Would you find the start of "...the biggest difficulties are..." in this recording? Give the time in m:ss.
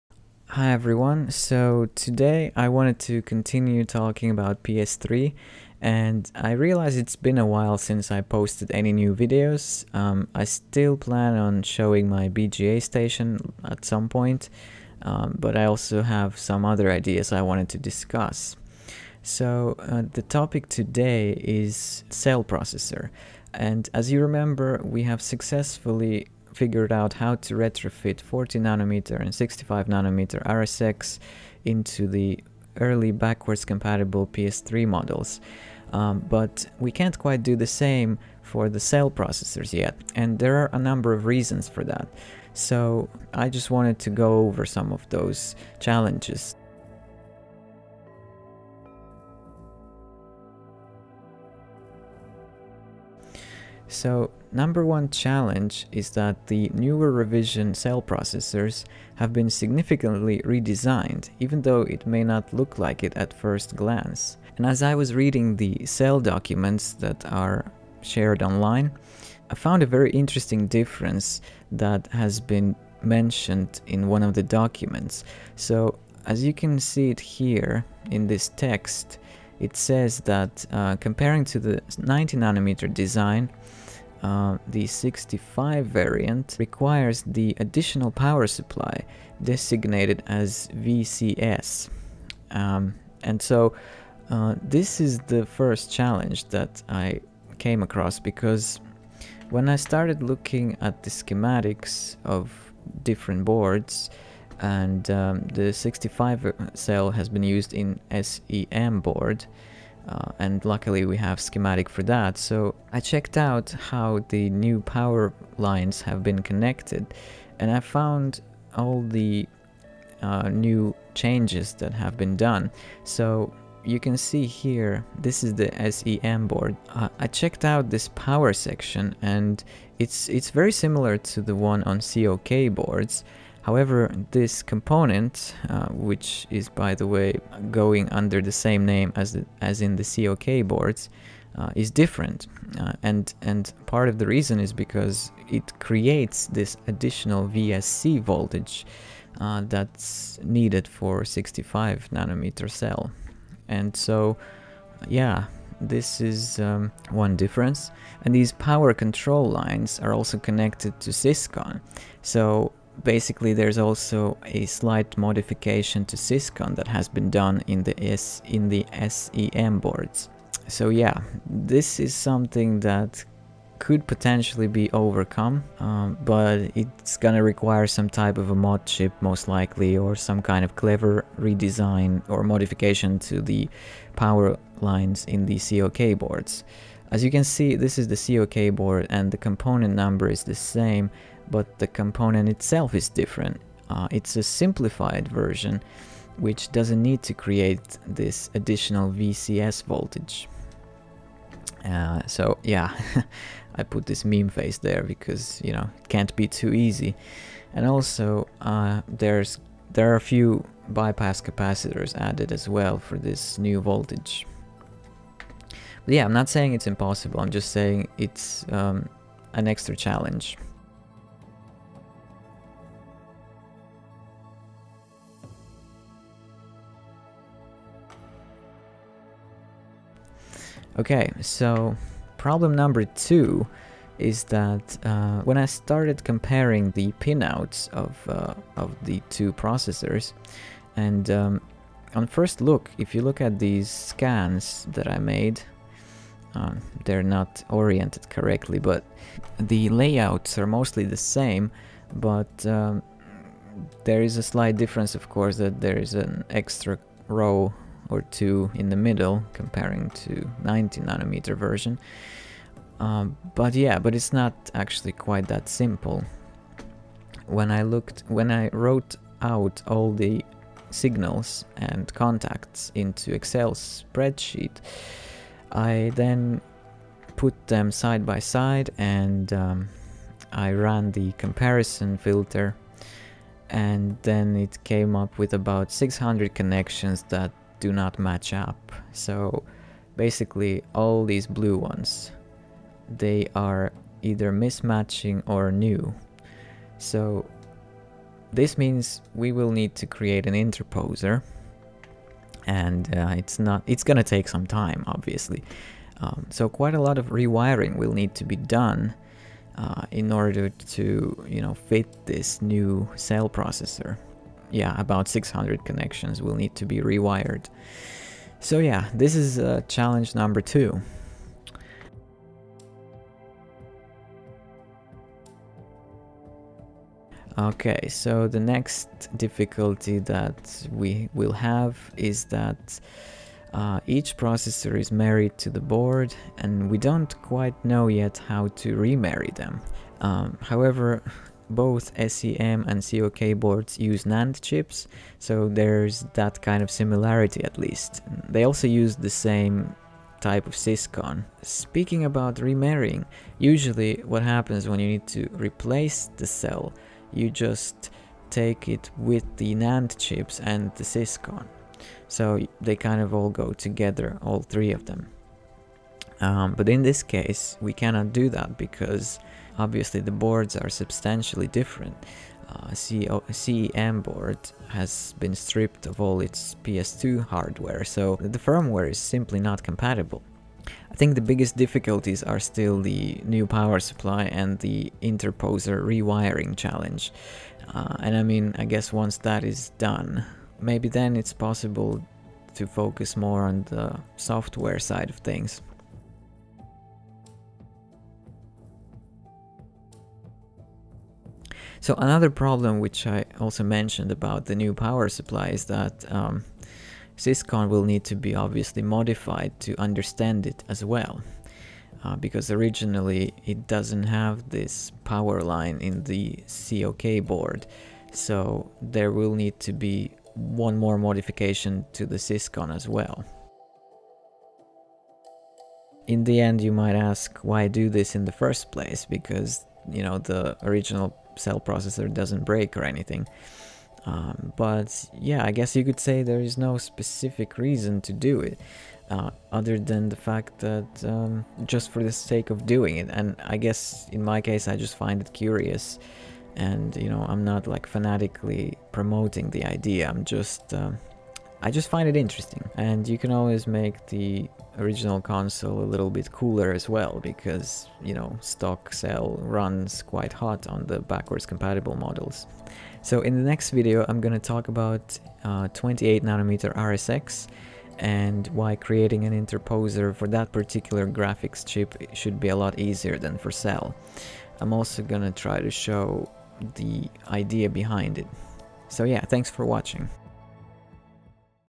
6:21.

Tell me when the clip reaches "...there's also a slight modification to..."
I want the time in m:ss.
2:43.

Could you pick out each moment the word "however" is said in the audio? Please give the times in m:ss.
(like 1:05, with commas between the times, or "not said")
2:13, 5:40.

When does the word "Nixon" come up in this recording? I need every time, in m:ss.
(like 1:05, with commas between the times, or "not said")
not said.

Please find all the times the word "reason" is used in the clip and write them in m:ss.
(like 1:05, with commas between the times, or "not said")
0:41, 2:24, 7:17.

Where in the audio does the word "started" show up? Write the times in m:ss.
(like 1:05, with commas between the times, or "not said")
1:39, 3:55.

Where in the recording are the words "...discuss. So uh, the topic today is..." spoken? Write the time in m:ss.
0:17.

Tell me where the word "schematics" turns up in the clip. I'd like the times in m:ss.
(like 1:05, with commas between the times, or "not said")
1:41, 1:51.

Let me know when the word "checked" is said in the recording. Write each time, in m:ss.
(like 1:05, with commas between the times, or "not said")
1:52, 2:07.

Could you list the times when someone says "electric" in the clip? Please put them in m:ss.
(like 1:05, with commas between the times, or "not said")
not said.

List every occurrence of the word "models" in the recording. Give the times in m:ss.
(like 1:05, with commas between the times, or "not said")
0:34, 7:42.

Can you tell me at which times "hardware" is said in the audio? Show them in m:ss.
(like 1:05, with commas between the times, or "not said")
6:17.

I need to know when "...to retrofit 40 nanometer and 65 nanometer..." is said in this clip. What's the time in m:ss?
0:27.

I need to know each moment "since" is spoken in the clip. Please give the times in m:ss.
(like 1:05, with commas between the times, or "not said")
0:07.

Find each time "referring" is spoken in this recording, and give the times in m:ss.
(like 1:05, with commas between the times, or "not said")
not said.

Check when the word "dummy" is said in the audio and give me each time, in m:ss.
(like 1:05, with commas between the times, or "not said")
not said.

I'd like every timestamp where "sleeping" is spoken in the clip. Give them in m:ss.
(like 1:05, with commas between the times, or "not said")
not said.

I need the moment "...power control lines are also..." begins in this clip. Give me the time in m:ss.
2:38.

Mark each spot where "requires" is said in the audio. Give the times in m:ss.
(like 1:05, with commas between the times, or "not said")
1:26, 2:57.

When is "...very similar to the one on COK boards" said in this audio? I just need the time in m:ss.
2:10.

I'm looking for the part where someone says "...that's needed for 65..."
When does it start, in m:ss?
2:29.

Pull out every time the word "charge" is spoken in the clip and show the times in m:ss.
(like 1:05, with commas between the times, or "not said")
not said.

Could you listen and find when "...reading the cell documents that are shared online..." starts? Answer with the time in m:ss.
1:05.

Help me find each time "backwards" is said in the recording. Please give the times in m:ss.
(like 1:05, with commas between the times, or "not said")
0:33, 7:41.